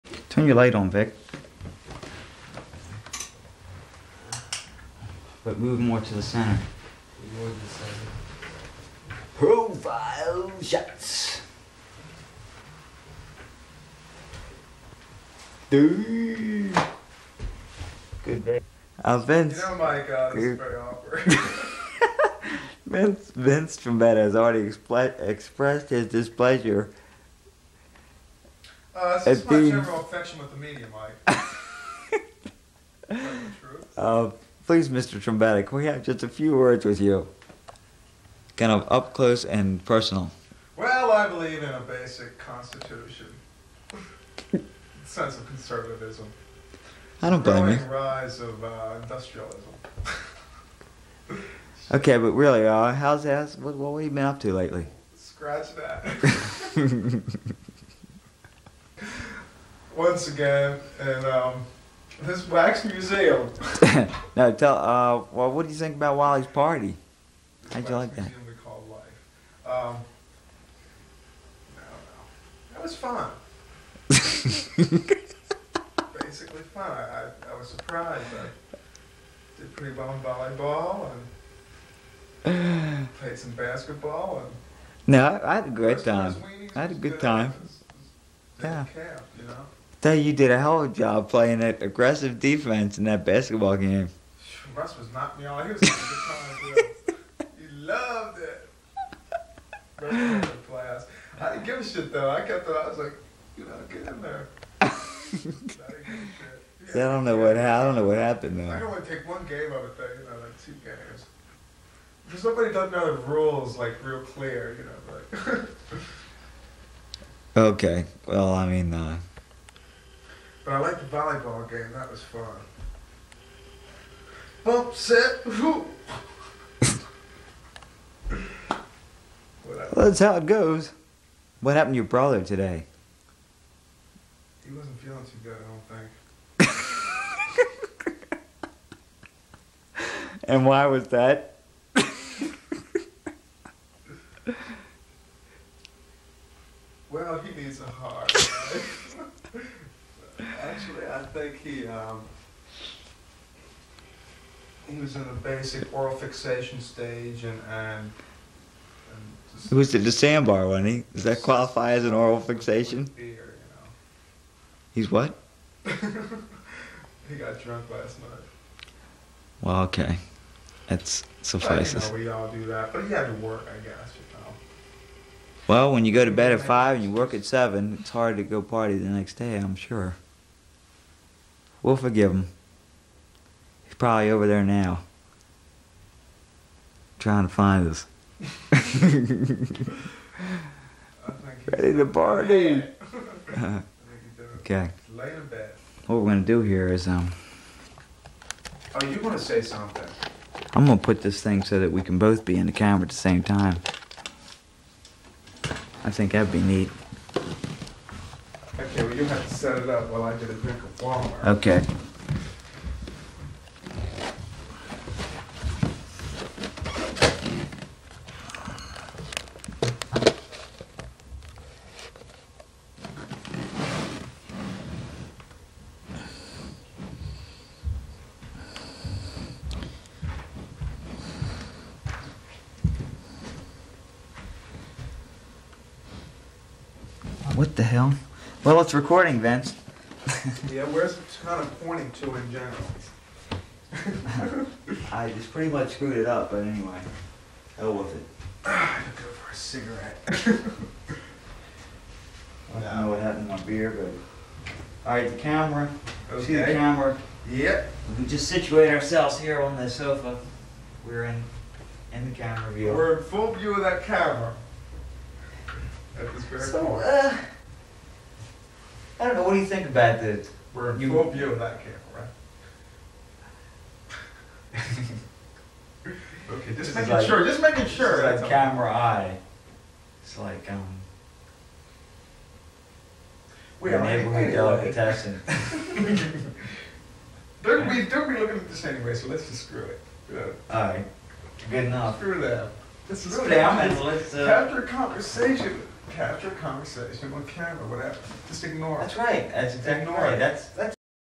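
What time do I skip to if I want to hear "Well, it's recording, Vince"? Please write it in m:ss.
3:58.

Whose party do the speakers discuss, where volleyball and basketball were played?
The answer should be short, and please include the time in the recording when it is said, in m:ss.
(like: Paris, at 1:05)
Wally's, at 1:06.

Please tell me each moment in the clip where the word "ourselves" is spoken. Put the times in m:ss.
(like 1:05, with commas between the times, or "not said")
4:18.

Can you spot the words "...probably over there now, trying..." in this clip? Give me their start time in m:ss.
3:03.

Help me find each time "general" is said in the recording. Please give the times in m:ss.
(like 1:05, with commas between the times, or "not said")
0:29, 4:02.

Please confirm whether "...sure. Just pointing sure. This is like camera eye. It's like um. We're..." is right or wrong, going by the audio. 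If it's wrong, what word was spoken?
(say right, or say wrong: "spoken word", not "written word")
wrong: "making", not "pointing".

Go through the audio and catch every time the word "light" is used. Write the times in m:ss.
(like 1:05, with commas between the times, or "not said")
0:00.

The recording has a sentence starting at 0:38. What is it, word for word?
Kind of up close and personal.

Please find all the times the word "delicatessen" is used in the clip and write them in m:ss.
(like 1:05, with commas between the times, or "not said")
4:44.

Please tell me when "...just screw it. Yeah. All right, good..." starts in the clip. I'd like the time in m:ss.
4:49.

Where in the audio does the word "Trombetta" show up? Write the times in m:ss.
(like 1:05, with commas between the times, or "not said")
0:23, 0:35.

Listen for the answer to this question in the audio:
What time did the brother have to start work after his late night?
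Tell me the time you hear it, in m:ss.
2:57.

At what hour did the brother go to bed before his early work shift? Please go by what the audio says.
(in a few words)
5.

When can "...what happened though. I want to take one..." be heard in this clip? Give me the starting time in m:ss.
1:48.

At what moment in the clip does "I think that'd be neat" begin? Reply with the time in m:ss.
3:26.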